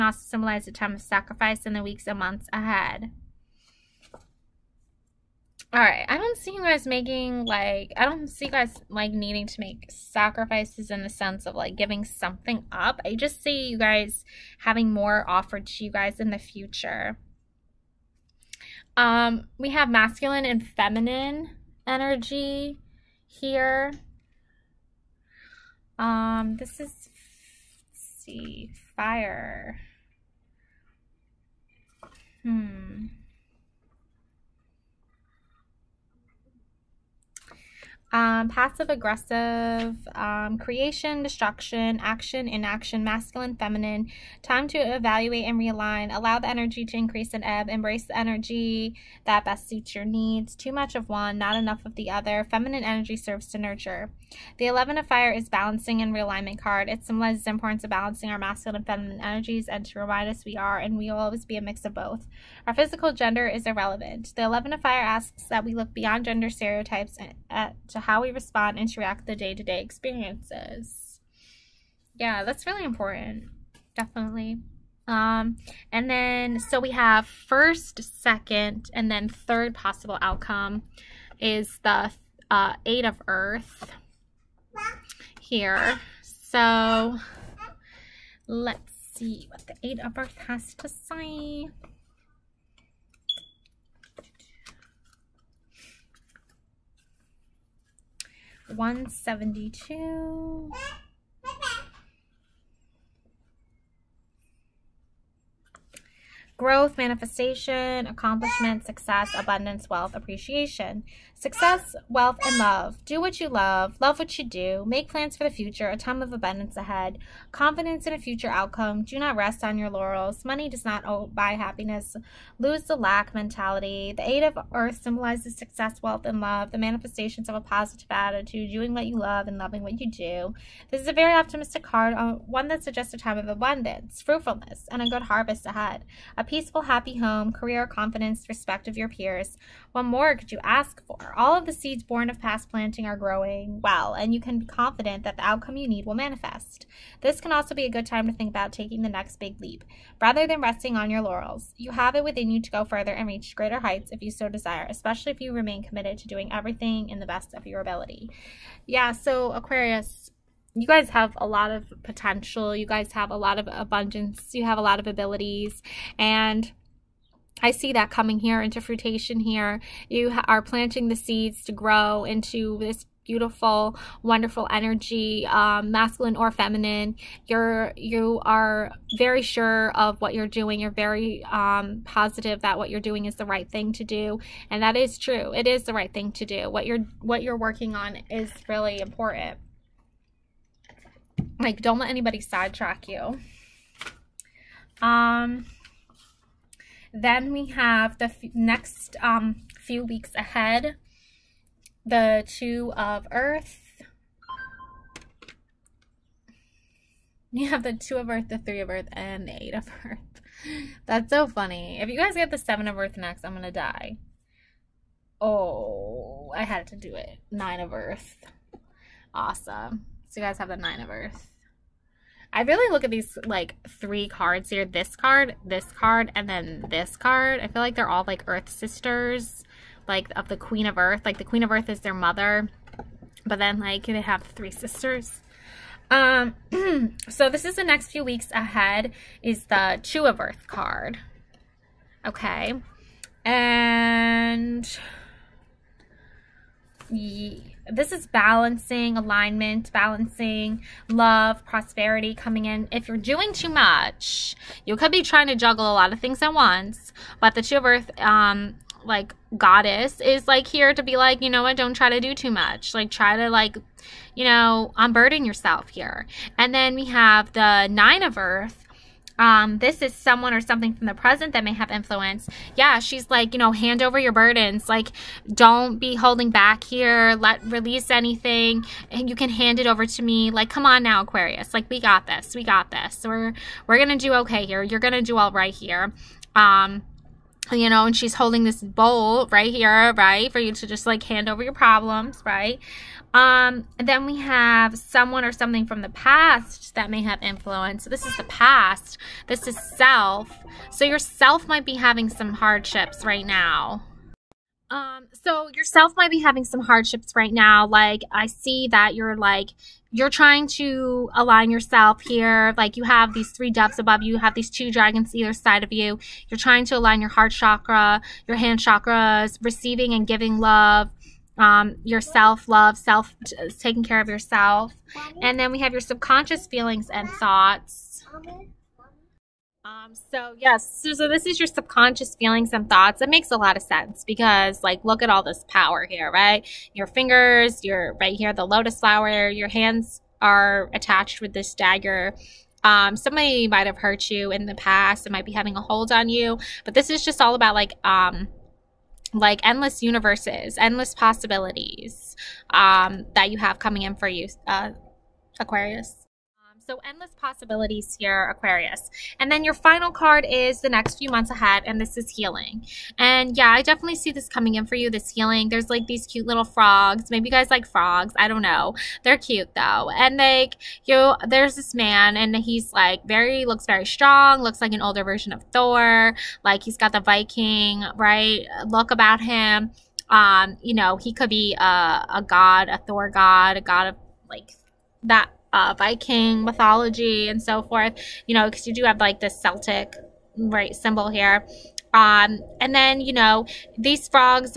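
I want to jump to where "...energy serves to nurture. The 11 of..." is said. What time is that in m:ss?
0:52.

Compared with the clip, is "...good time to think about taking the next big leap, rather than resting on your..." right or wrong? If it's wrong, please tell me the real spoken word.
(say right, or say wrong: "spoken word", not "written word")
right.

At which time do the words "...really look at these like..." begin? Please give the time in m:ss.
3:42.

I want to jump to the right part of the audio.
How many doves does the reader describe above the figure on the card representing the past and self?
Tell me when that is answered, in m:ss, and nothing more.
5:13.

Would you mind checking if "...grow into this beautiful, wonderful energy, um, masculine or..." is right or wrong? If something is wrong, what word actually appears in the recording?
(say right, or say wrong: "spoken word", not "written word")
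right.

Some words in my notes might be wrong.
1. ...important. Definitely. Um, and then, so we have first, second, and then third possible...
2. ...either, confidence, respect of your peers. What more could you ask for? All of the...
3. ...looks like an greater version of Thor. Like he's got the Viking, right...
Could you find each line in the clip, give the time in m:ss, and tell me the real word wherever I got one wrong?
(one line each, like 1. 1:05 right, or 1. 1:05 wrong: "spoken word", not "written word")
1. 1:12 right
2. 2:17 wrong: "career", not "either"
3. 6:14 wrong: "older", not "greater".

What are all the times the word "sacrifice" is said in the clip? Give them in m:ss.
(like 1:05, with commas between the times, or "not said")
0:01, 0:09.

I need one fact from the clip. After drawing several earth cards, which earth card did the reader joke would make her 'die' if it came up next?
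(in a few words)
seven of earth.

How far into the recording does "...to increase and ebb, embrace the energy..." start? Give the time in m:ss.
0:46.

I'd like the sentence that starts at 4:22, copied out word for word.
Like try to like, you know, unburden yourself here.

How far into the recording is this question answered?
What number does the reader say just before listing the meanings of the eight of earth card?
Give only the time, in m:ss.
1:38.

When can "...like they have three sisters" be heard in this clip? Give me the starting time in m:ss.
3:53.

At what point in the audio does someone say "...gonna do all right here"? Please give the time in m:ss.
4:44.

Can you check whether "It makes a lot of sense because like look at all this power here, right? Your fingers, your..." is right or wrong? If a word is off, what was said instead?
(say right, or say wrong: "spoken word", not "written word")
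right.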